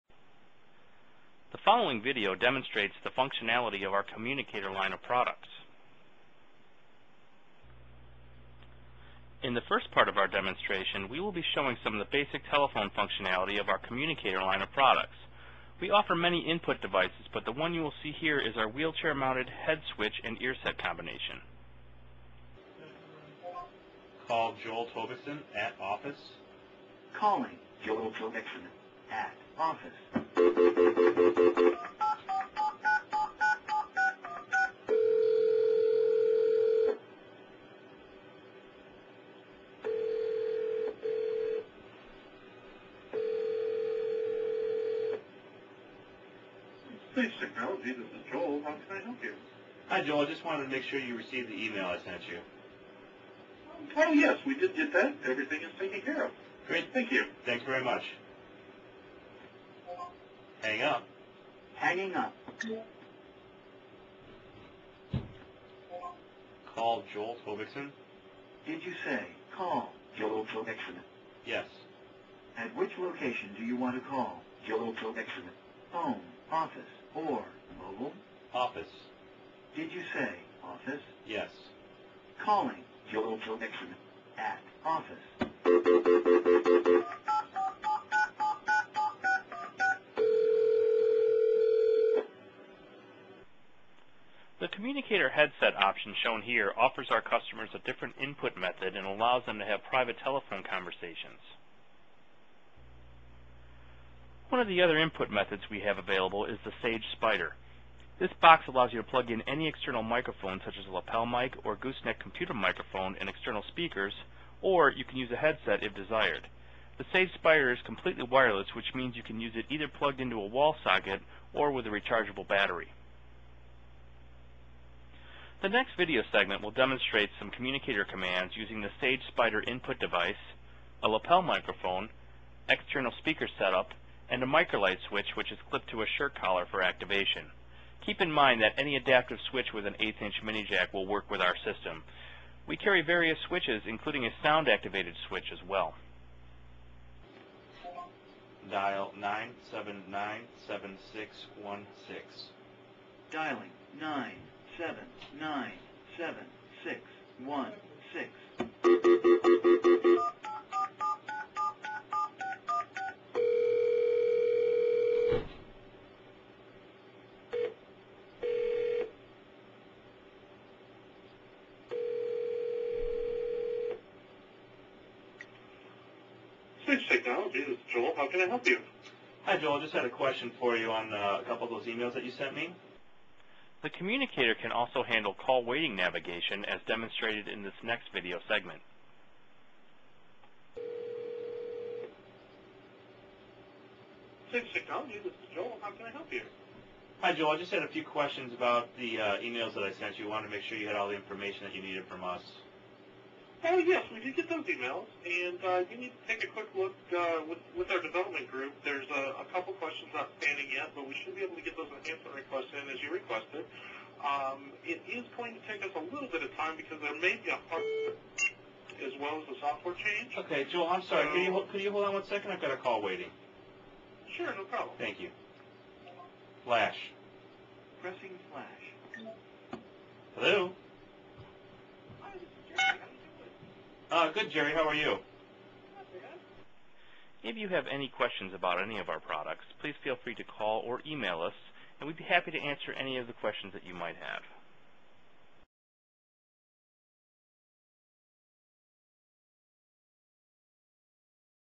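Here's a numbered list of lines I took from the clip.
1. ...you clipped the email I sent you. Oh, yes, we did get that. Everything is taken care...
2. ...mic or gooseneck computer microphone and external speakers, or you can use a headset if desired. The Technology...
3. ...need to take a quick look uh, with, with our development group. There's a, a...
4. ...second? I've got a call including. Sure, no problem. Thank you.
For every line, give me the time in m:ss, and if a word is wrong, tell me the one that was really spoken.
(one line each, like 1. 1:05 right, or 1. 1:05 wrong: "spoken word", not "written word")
1. 0:50 wrong: "received", not "clipped"
2. 1:51 wrong: "Sage", not "Technology"
3. 3:26 right
4. 3:42 wrong: "waiting", not "including".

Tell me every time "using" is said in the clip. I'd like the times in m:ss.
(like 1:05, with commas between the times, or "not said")
2:08.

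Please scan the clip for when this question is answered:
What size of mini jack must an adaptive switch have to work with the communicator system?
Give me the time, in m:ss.
2:19.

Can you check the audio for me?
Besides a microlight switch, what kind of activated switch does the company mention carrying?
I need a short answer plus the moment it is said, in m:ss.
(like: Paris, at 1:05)
Sound activated switch, at 2:24.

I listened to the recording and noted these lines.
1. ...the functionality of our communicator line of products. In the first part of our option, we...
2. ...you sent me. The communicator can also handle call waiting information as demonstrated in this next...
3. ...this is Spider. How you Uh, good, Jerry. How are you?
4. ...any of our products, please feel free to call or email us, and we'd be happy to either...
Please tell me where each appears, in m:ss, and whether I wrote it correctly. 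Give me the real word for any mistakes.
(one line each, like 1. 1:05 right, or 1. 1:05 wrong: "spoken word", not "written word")
1. 0:03 wrong: "demonstration", not "option"
2. 3:02 wrong: "navigation", not "information"
3. 3:52 wrong: "Jerry", not "Spider"
4. 3:58 wrong: "answer", not "either".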